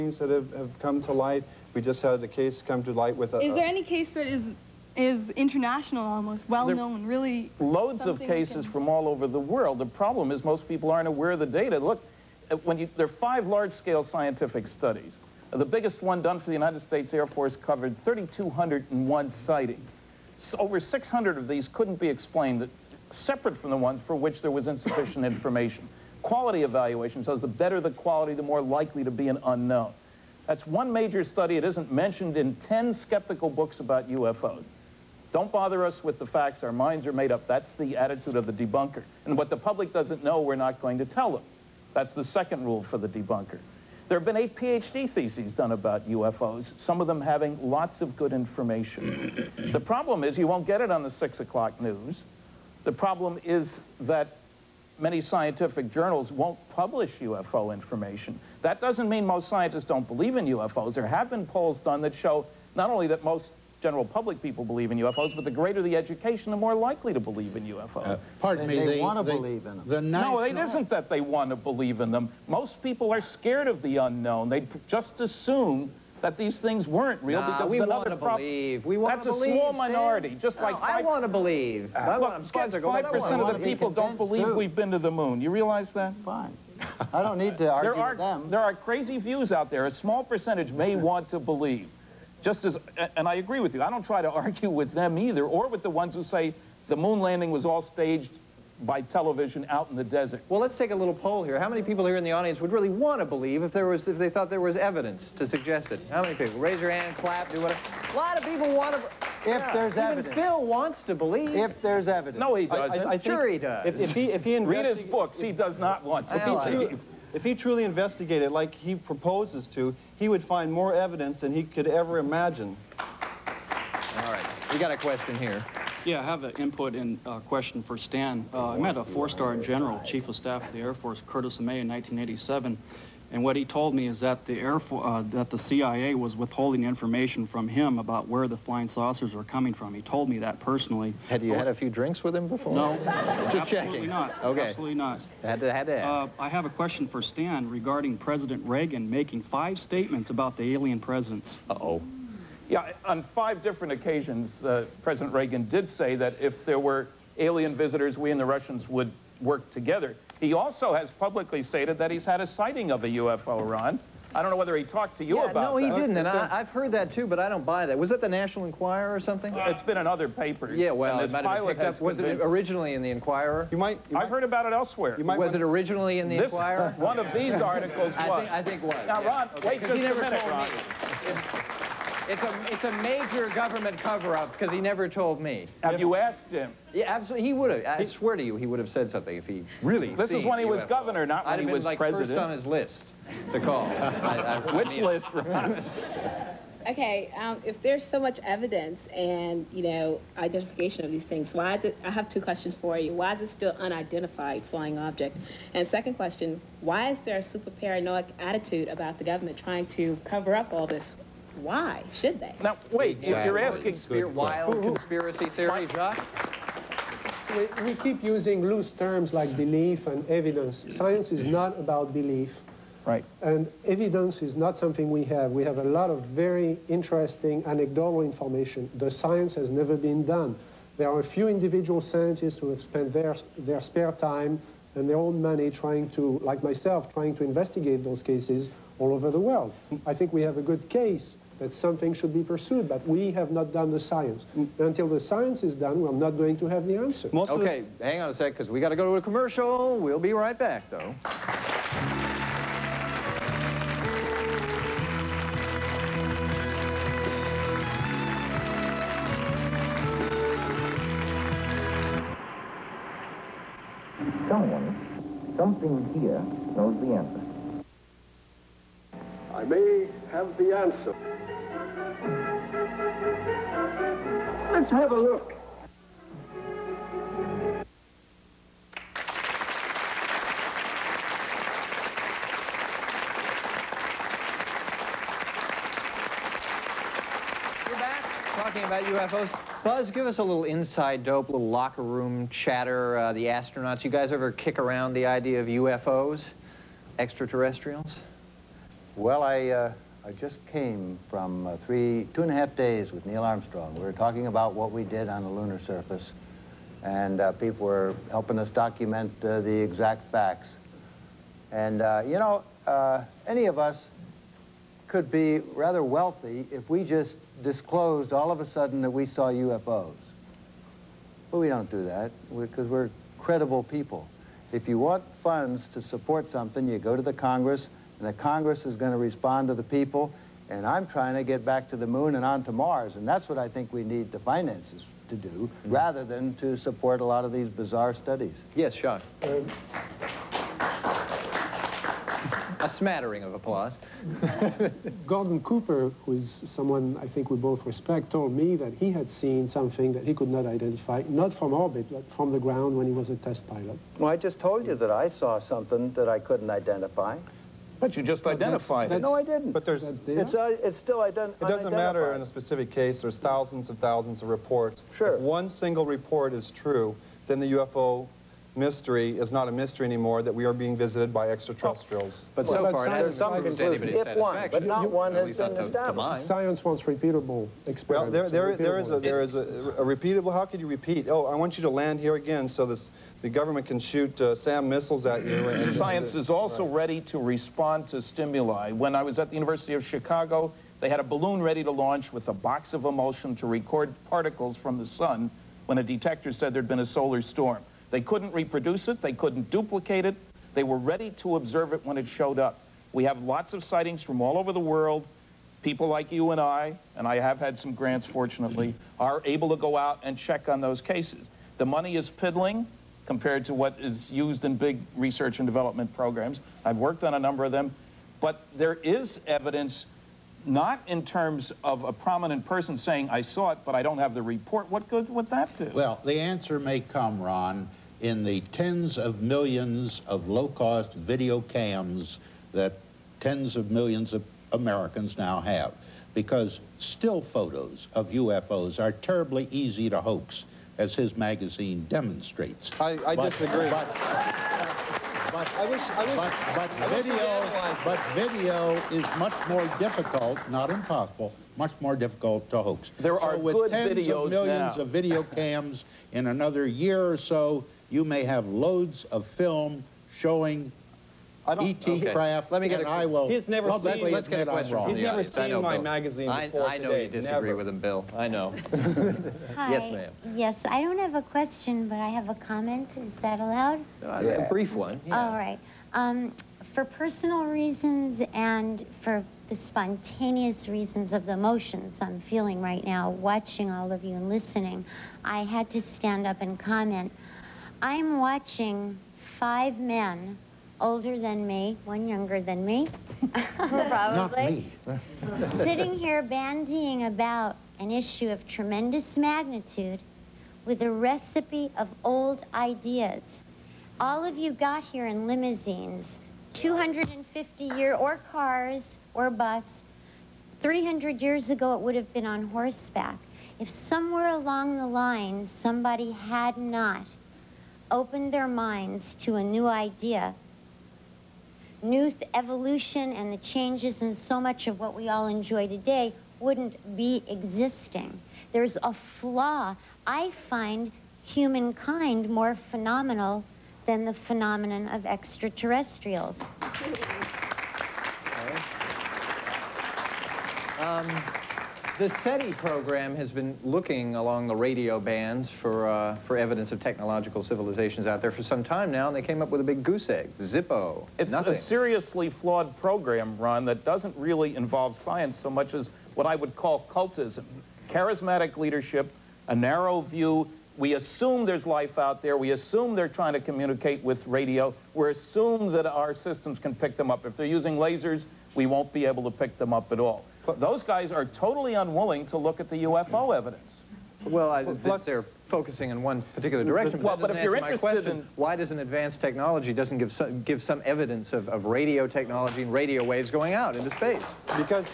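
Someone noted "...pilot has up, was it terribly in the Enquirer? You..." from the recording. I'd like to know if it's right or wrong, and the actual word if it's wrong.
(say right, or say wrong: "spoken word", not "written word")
wrong: "originally", not "terribly".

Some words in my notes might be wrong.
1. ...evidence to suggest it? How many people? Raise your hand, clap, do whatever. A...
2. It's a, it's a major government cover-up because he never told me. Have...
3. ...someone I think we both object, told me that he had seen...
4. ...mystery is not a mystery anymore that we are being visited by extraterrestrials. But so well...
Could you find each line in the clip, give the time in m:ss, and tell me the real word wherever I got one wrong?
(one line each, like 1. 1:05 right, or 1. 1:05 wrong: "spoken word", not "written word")
1. 1:44 right
2. 3:02 right
3. 5:46 wrong: "respect", not "object"
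4. 6:08 right.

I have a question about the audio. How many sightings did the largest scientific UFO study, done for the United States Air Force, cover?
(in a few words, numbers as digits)
3,201.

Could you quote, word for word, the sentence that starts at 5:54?
Well, I just told you that I saw something that I couldn't identify.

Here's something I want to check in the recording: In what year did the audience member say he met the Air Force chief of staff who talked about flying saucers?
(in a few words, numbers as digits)
1987.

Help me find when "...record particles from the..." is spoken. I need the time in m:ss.
6:33.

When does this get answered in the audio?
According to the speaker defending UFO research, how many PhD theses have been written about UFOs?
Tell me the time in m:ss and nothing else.
0:44.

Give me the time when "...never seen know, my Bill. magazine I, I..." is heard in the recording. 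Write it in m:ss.
7:45.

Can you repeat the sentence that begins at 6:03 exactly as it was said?
There's thousands and thousands of reports.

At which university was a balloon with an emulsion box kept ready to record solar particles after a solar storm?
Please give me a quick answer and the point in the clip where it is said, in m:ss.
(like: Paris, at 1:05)
University of Chicago, at 6:29.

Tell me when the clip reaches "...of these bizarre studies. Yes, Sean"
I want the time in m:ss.
5:37.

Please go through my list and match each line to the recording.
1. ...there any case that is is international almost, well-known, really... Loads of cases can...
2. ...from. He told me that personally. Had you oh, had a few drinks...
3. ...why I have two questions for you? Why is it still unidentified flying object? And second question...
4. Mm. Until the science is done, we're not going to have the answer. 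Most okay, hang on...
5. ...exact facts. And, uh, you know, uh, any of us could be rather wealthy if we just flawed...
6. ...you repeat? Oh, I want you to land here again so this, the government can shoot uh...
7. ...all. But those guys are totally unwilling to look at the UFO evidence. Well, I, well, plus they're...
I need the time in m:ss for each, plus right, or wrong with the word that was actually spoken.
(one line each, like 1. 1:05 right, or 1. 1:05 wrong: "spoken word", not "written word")
1. 0:03 right
2. 2:19 right
3. 3:21 right
4. 4:04 right
5. 5:09 wrong: "disclosed", not "flawed"
6. 6:20 right
7. 9:30 right.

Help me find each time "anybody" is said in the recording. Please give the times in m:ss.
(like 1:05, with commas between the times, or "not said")
6:13.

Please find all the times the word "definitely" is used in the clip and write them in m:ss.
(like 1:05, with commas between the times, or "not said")
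not said.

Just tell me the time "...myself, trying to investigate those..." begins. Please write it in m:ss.
3:56.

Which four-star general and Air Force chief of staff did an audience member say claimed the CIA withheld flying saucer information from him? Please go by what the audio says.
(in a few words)
Curtis LeMay.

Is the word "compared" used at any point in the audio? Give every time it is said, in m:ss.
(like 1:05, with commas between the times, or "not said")
6:53.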